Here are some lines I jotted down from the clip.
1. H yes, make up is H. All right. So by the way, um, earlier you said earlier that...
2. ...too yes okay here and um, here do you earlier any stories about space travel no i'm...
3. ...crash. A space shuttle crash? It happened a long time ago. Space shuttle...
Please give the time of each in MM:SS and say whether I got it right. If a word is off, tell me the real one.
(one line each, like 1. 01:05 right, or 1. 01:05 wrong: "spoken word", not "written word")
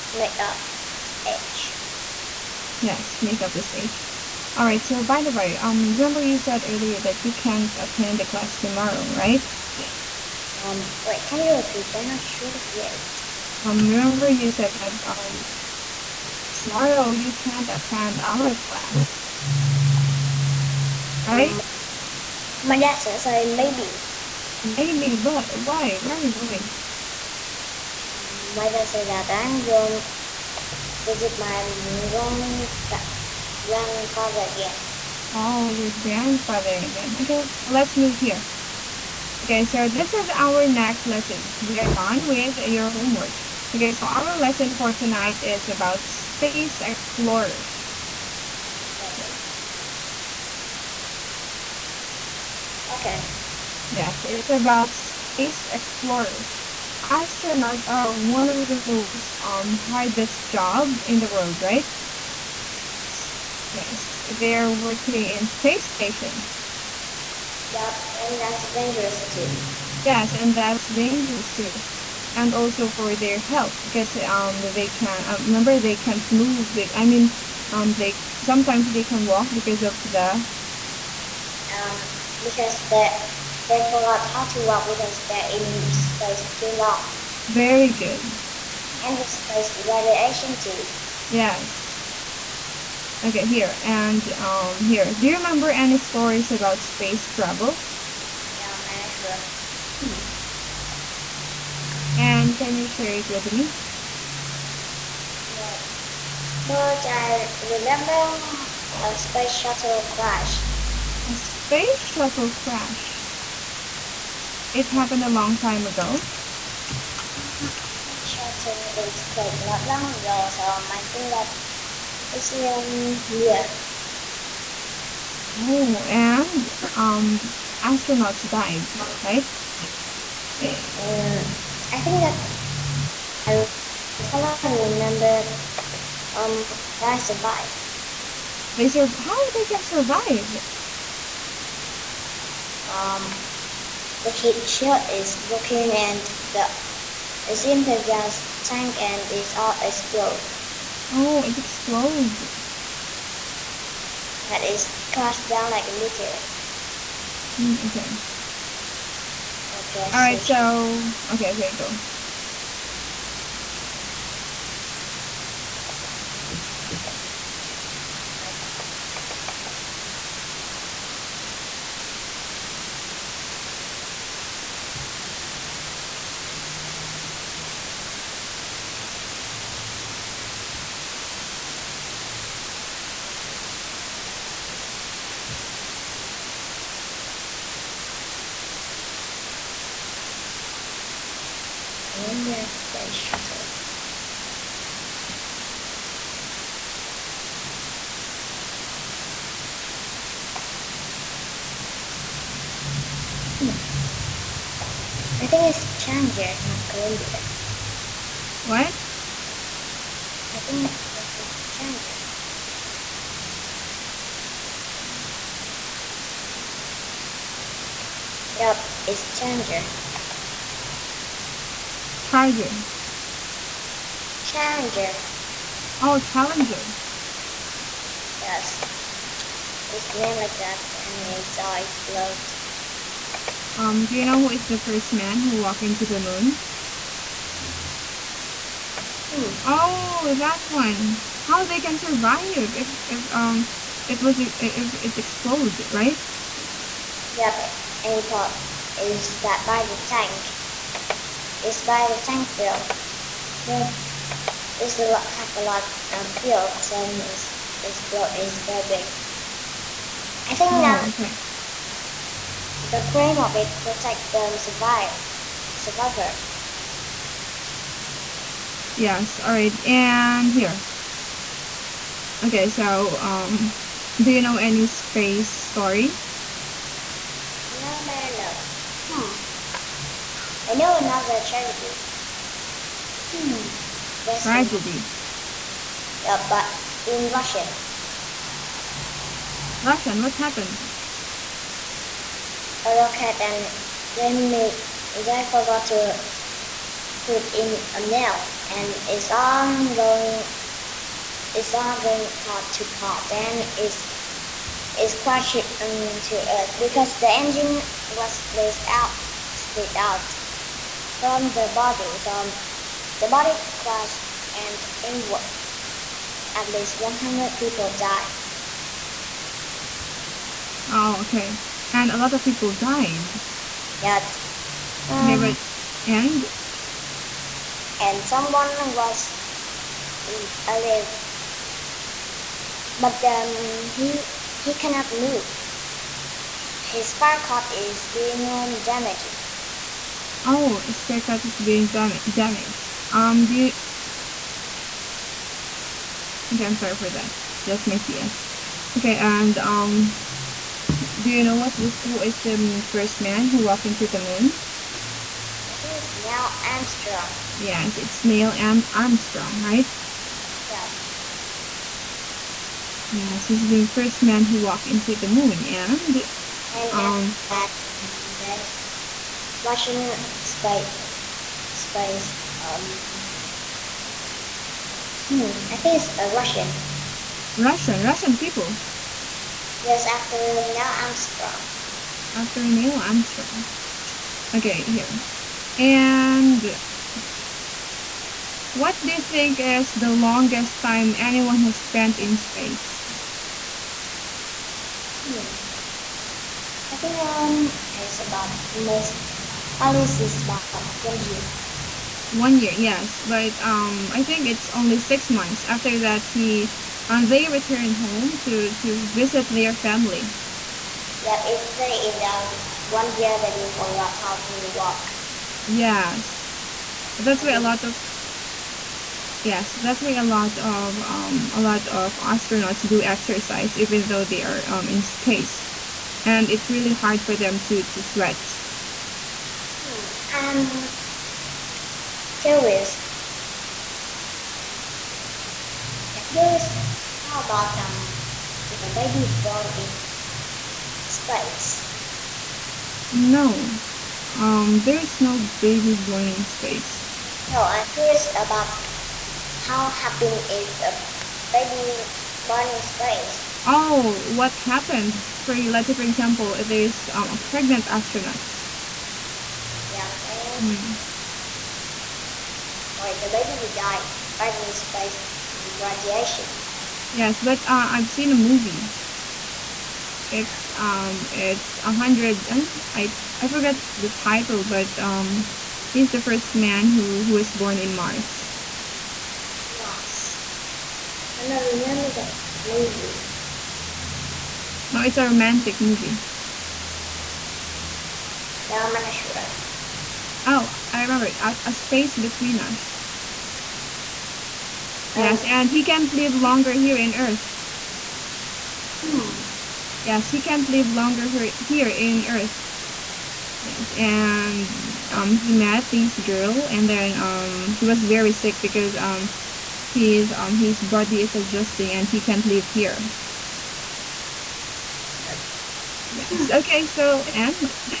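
1. 00:01 wrong: "remember", not "earlier"
2. 01:30 wrong: "remember", not "earlier"
3. 01:50 right.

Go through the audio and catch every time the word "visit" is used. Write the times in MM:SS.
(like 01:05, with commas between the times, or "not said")
00:31, 06:49.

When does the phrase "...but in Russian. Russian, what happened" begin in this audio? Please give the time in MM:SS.
04:46.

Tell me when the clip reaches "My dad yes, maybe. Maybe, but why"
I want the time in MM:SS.
00:22.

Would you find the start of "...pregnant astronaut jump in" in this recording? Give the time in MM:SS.
07:37.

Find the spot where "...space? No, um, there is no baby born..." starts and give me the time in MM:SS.
07:21.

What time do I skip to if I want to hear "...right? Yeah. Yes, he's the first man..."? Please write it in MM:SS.
05:59.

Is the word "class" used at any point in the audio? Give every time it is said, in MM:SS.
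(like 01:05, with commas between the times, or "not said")
00:08, 00:18.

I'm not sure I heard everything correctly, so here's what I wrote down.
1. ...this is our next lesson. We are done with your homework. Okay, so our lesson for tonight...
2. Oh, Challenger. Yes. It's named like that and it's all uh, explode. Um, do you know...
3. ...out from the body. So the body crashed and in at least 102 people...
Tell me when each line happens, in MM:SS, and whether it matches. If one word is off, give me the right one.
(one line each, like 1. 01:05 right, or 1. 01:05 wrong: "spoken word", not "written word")
1. 00:39 right
2. 03:45 right
3. 05:09 wrong: "100", not "102".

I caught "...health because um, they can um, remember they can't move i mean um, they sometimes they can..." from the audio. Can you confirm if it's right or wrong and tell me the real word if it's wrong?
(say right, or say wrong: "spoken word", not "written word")
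right.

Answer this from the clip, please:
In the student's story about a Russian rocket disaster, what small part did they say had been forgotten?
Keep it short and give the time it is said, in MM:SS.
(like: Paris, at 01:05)
a nail, at 04:57.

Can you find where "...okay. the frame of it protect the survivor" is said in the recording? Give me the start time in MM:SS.
04:21.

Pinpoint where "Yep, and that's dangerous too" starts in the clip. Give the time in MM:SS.
01:07.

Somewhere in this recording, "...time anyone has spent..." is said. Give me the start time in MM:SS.
06:30.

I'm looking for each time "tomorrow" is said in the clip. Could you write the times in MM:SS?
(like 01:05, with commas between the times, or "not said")
00:08, 00:16.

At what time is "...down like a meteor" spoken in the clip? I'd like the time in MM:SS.
02:35.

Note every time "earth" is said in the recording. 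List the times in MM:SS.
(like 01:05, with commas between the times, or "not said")
05:06, 08:17, 08:22.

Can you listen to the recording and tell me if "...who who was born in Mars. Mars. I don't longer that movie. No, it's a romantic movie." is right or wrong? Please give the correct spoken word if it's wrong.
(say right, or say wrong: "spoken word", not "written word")
wrong: "remember", not "longer".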